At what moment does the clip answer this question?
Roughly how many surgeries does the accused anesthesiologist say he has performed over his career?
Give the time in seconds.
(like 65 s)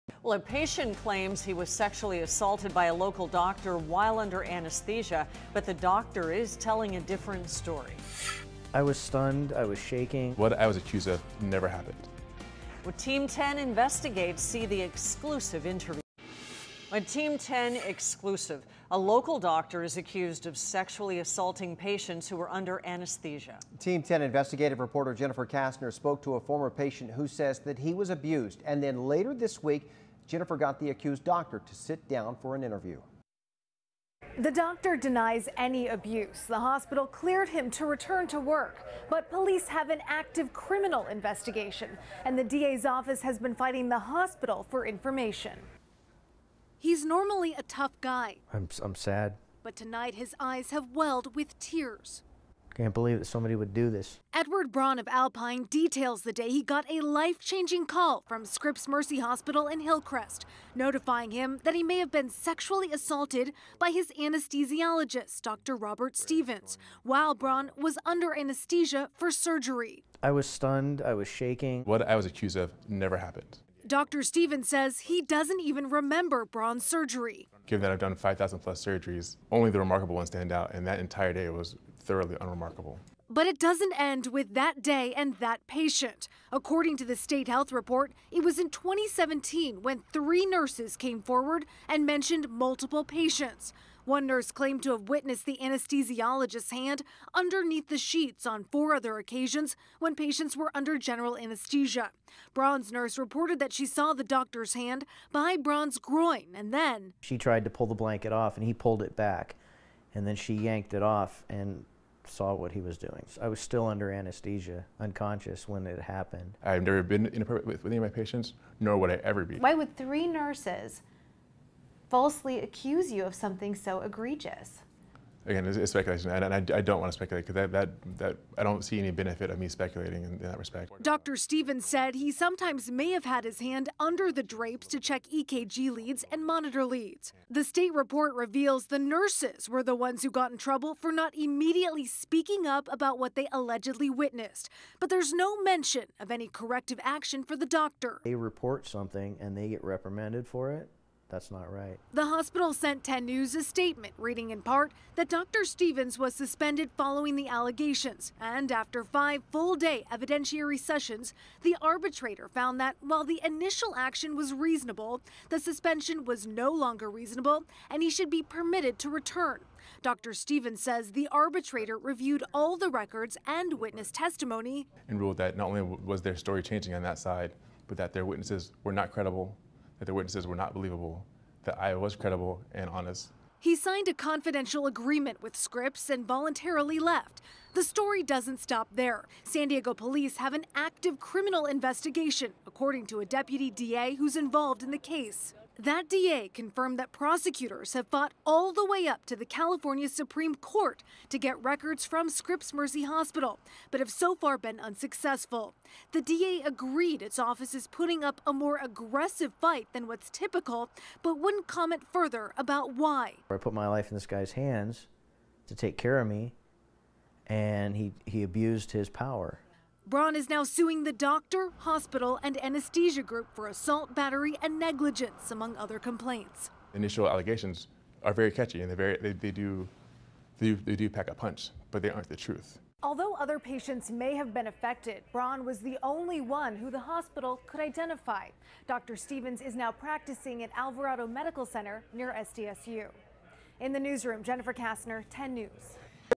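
78 s.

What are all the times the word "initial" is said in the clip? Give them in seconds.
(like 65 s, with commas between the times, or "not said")
163 s, 226 s.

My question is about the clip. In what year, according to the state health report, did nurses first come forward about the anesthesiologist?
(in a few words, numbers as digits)
2017.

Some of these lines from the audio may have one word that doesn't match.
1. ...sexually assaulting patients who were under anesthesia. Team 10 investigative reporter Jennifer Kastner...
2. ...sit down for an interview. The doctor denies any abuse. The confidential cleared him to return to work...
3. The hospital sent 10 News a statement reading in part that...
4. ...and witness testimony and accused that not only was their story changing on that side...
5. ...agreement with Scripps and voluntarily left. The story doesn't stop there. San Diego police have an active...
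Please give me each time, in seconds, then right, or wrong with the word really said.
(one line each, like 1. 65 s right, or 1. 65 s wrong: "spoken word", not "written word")
1. 20 s right
2. 31 s wrong: "hospital", not "confidential"
3. 152 s right
4. 173 s wrong: "ruled", not "accused"
5. 184 s right.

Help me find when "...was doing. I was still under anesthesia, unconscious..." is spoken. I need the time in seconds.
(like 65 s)
112 s.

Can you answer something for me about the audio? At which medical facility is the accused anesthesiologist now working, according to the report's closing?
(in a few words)
Alvarado Medical Center.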